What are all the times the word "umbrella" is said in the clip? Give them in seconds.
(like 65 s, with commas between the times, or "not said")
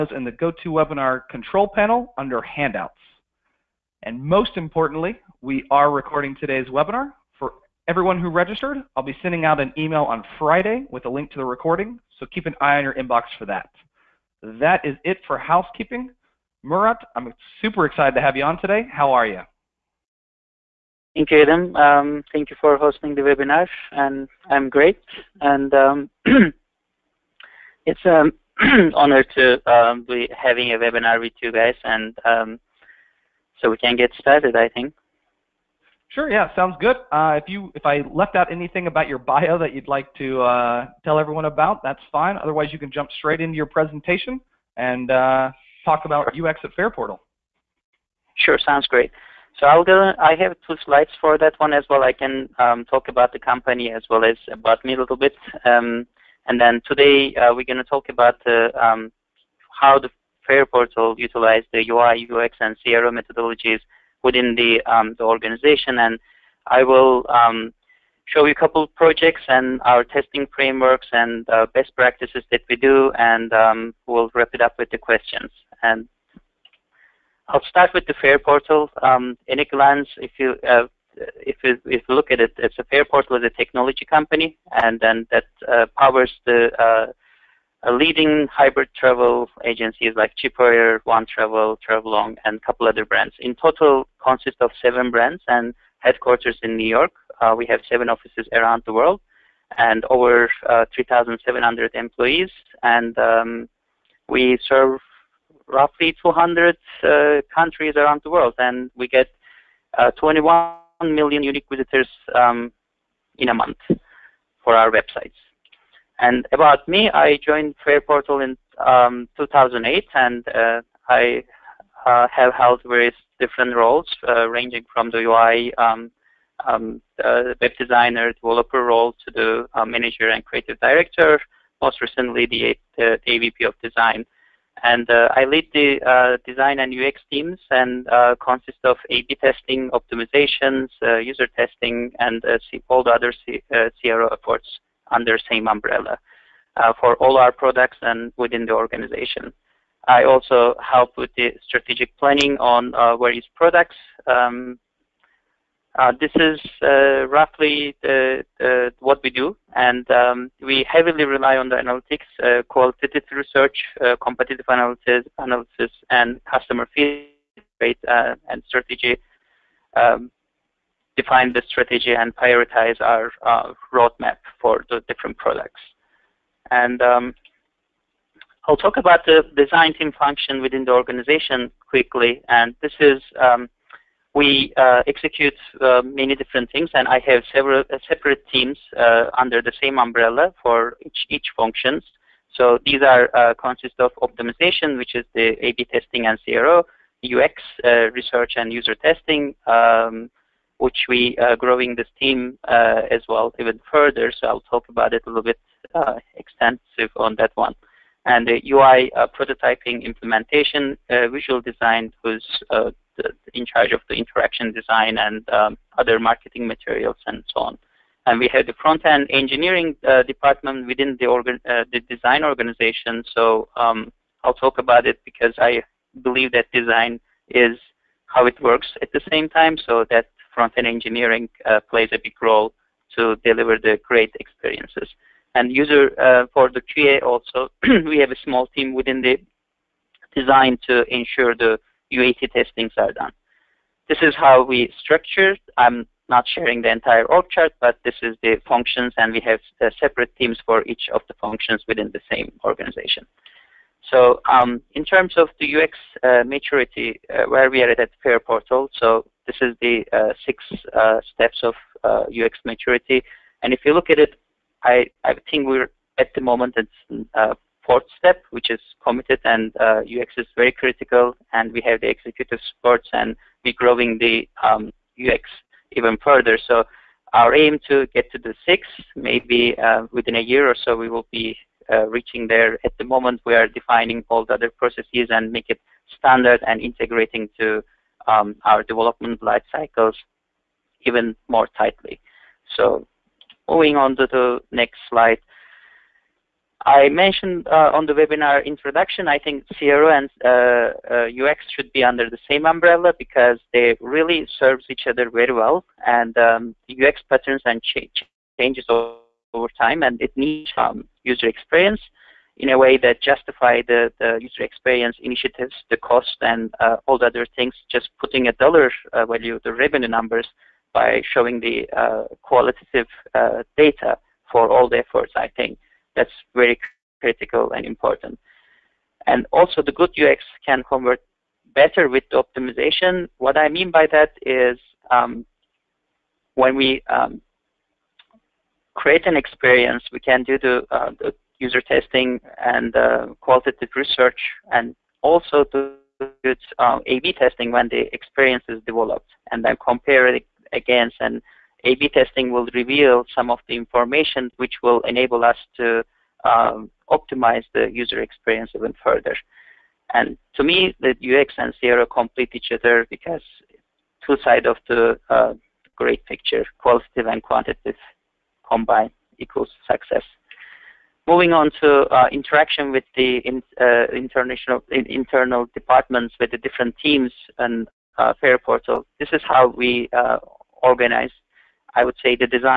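145 s, 189 s, 302 s.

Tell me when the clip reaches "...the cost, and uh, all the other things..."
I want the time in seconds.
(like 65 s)
315 s.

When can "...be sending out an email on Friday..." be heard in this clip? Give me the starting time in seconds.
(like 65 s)
9 s.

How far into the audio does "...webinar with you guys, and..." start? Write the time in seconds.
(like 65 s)
30 s.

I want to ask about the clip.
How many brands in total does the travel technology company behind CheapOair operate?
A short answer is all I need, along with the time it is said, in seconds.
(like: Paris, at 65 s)
7, at 94 s.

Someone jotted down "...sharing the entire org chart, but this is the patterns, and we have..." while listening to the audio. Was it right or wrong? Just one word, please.
wrong.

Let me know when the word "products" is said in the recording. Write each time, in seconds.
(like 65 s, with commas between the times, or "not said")
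147 s, 153 s, 175 s.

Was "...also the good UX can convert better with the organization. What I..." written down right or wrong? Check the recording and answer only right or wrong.
wrong.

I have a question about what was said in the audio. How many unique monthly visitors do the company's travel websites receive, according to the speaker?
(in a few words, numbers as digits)
21 million.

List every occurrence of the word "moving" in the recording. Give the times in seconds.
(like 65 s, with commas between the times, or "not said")
293 s, 371 s.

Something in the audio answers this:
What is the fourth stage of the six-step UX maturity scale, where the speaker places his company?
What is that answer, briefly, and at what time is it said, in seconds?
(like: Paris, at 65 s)
committed, at 269 s.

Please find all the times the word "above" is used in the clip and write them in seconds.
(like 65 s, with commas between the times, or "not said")
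not said.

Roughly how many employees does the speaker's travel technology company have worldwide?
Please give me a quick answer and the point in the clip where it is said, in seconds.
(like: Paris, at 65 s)
3,700, at 100 s.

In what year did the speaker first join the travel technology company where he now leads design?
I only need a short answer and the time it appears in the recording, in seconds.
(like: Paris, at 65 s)
2008, at 119 s.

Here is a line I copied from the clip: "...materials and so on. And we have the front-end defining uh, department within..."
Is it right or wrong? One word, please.
wrong.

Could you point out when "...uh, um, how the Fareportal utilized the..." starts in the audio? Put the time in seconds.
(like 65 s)
58 s.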